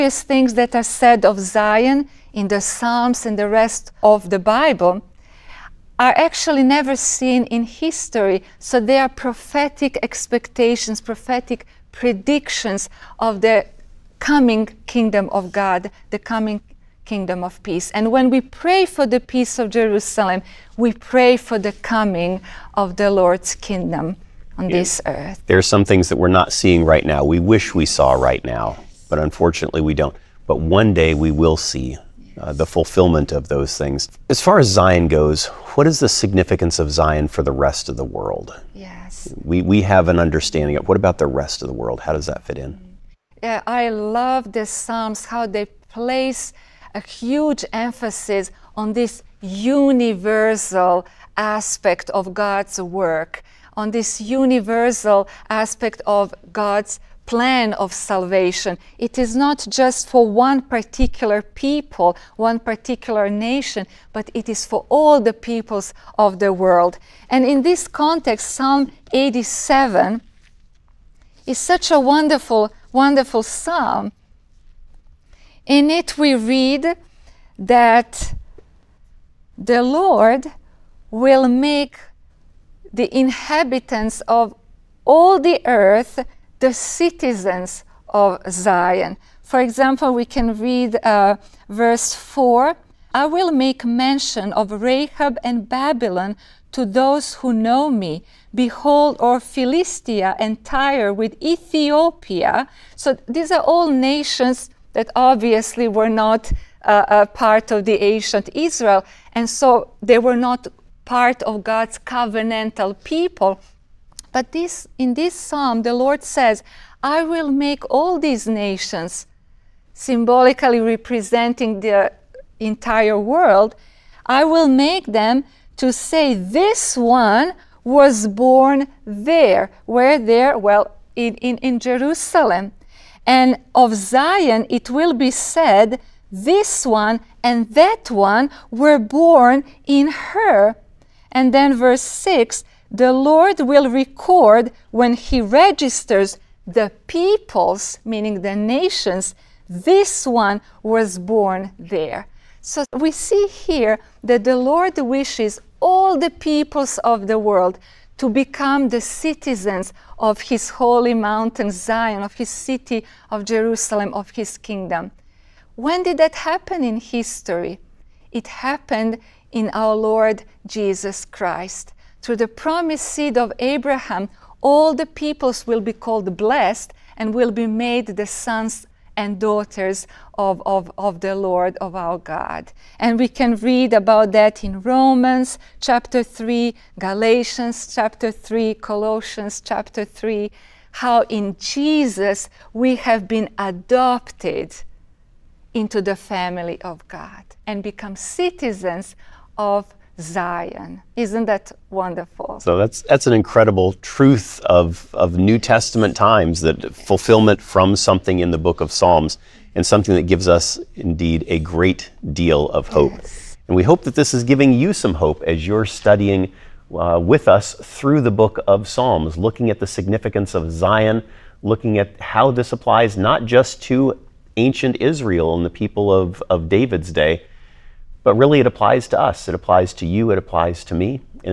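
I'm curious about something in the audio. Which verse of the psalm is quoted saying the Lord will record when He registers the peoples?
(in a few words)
Verse 6.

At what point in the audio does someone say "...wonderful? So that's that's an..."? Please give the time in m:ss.
3:21.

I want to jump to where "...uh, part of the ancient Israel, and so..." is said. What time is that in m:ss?
1:47.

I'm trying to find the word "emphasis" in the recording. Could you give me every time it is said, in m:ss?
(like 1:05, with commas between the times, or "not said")
0:47.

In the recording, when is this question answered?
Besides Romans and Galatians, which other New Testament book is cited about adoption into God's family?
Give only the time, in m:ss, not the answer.
3:08.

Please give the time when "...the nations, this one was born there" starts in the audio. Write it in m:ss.
2:28.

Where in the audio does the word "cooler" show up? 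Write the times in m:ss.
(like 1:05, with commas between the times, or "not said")
not said.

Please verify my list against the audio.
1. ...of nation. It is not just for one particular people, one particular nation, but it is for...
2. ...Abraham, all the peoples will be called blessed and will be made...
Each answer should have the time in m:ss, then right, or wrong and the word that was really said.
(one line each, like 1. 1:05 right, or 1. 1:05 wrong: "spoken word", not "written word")
1. 0:57 wrong: "salvation", not "nation"
2. 2:53 right.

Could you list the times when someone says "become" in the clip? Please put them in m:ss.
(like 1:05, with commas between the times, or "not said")
2:38, 3:17.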